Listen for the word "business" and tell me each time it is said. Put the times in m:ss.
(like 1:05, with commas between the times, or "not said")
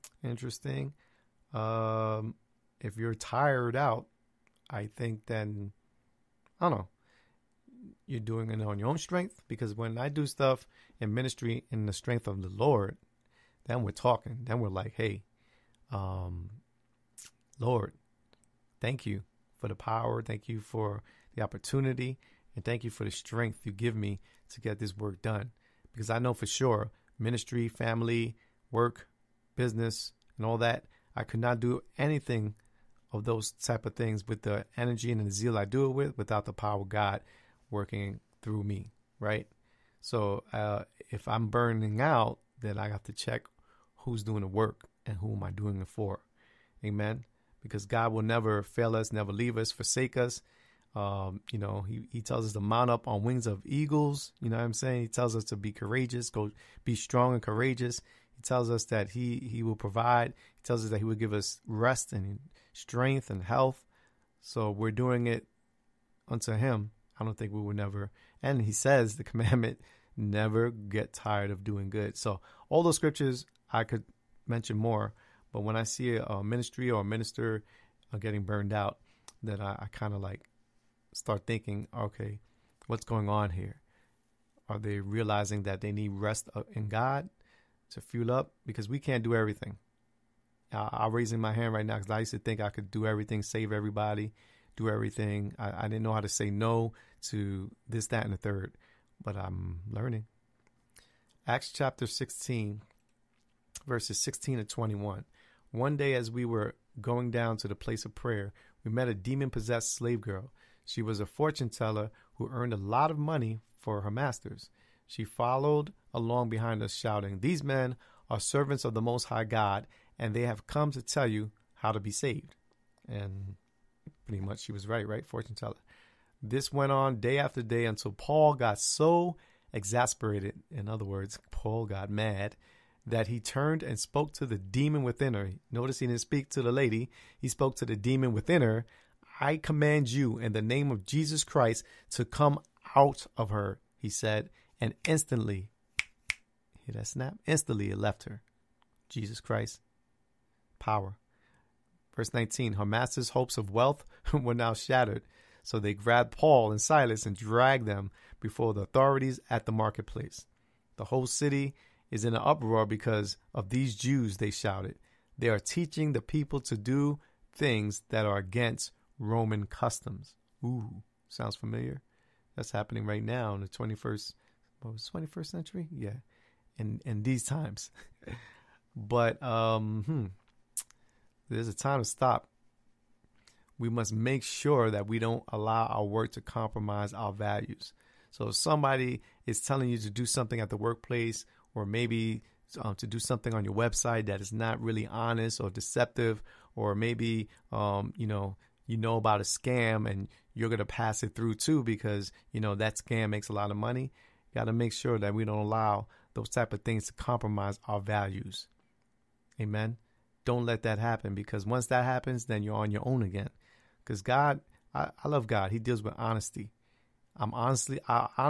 0:29.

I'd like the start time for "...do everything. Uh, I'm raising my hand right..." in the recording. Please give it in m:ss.
1:29.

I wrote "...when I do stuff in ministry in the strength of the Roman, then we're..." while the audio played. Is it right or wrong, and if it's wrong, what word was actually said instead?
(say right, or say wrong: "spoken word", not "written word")
wrong: "Lord", not "Roman".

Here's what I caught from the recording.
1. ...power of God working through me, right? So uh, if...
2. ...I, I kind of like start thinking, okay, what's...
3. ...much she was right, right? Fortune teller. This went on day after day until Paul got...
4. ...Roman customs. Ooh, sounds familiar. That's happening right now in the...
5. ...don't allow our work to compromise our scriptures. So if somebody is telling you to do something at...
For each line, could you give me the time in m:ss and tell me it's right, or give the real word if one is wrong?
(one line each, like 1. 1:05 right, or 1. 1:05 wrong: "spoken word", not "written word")
1. 0:36 right
2. 1:19 right
3. 2:04 right
4. 2:49 right
5. 3:05 wrong: "values", not "scriptures".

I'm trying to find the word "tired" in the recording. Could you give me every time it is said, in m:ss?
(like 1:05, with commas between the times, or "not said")
0:03, 1:11.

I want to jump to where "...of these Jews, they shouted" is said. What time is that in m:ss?
2:43.